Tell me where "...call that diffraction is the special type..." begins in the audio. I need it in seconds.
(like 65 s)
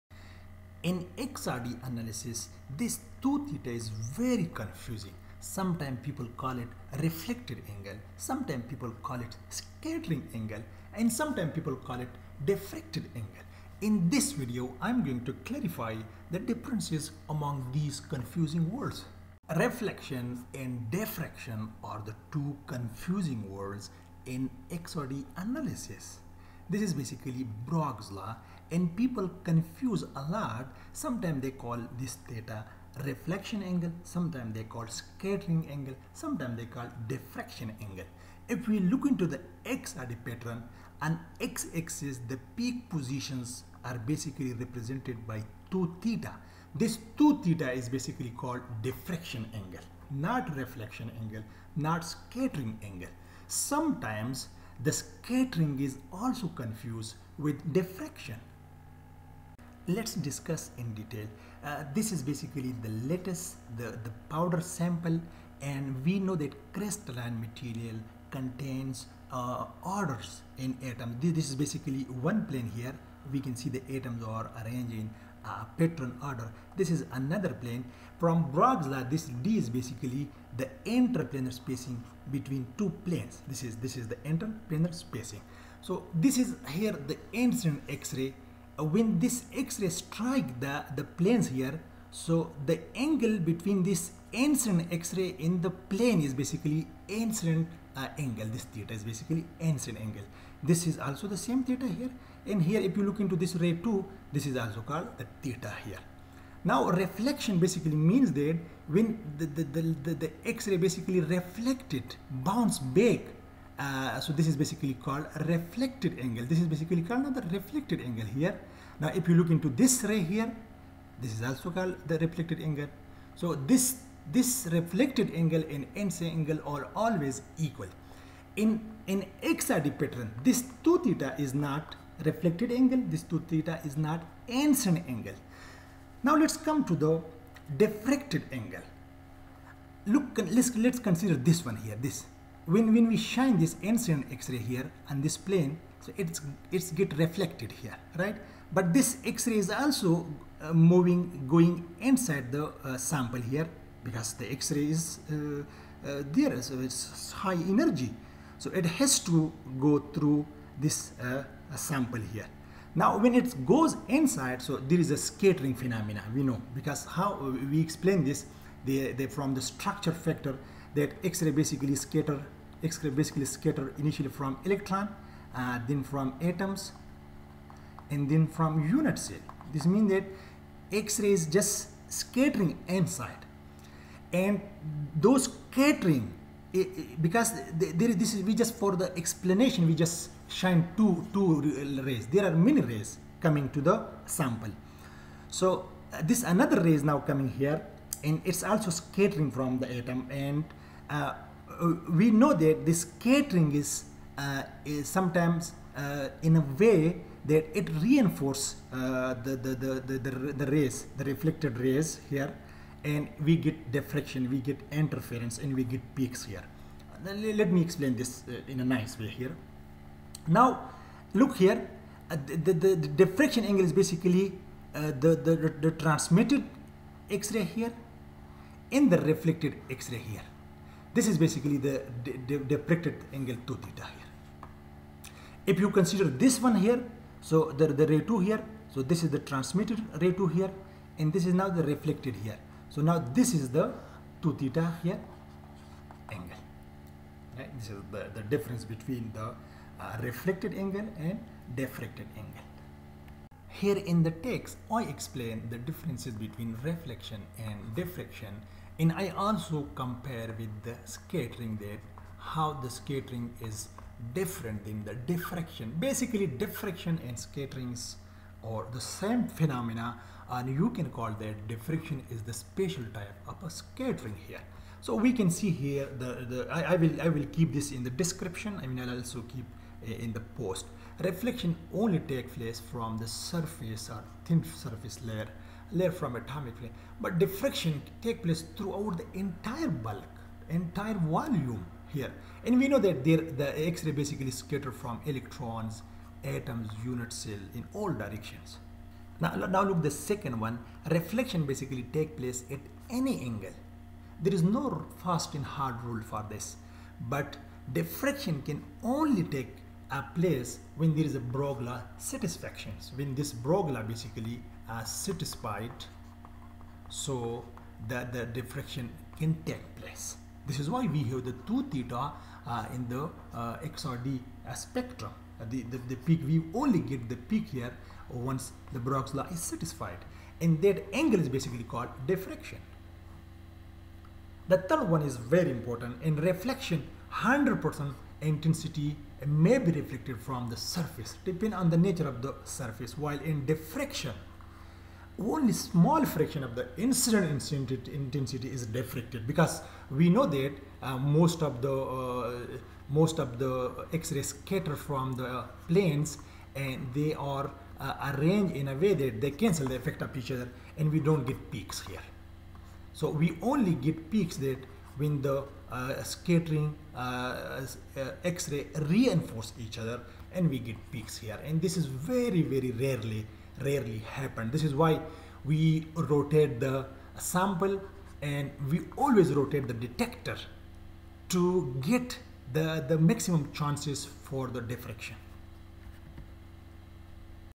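271 s.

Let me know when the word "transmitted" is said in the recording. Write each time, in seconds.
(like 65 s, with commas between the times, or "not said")
225 s, 239 s.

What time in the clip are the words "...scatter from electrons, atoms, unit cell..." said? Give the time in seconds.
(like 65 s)
294 s.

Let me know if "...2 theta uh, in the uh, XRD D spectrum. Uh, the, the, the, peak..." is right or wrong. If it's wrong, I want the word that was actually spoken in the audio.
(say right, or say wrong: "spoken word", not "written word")
right.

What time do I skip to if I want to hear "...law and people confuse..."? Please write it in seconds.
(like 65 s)
28 s.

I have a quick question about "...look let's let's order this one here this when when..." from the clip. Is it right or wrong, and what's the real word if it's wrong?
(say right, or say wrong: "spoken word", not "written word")
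wrong: "consider", not "order".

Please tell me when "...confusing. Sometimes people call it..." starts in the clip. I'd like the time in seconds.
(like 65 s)
4 s.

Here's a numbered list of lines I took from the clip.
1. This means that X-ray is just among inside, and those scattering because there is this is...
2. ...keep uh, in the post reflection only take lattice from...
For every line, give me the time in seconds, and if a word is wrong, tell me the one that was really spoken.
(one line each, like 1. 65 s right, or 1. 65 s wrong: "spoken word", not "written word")
1. 179 s wrong: "scattering", not "among"
2. 279 s wrong: "place", not "lattice".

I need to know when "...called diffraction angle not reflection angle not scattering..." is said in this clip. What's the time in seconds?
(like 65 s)
48 s.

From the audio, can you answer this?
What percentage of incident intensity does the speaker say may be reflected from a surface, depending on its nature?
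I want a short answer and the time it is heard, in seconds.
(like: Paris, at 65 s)
100%, at 337 s.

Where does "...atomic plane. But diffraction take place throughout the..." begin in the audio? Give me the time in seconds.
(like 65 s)
286 s.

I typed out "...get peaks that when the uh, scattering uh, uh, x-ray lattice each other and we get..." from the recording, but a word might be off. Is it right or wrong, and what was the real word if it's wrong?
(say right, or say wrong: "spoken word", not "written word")
wrong: "reinforce", not "lattice".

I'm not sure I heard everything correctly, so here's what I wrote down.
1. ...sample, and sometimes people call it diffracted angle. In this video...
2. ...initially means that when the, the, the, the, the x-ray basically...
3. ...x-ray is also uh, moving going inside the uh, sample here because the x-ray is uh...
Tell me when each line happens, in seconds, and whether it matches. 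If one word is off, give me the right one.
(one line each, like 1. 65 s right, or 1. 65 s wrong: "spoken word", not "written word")
1. 10 s wrong: "angle", not "sample"
2. 107 s wrong: "basically", not "initially"
3. 149 s right.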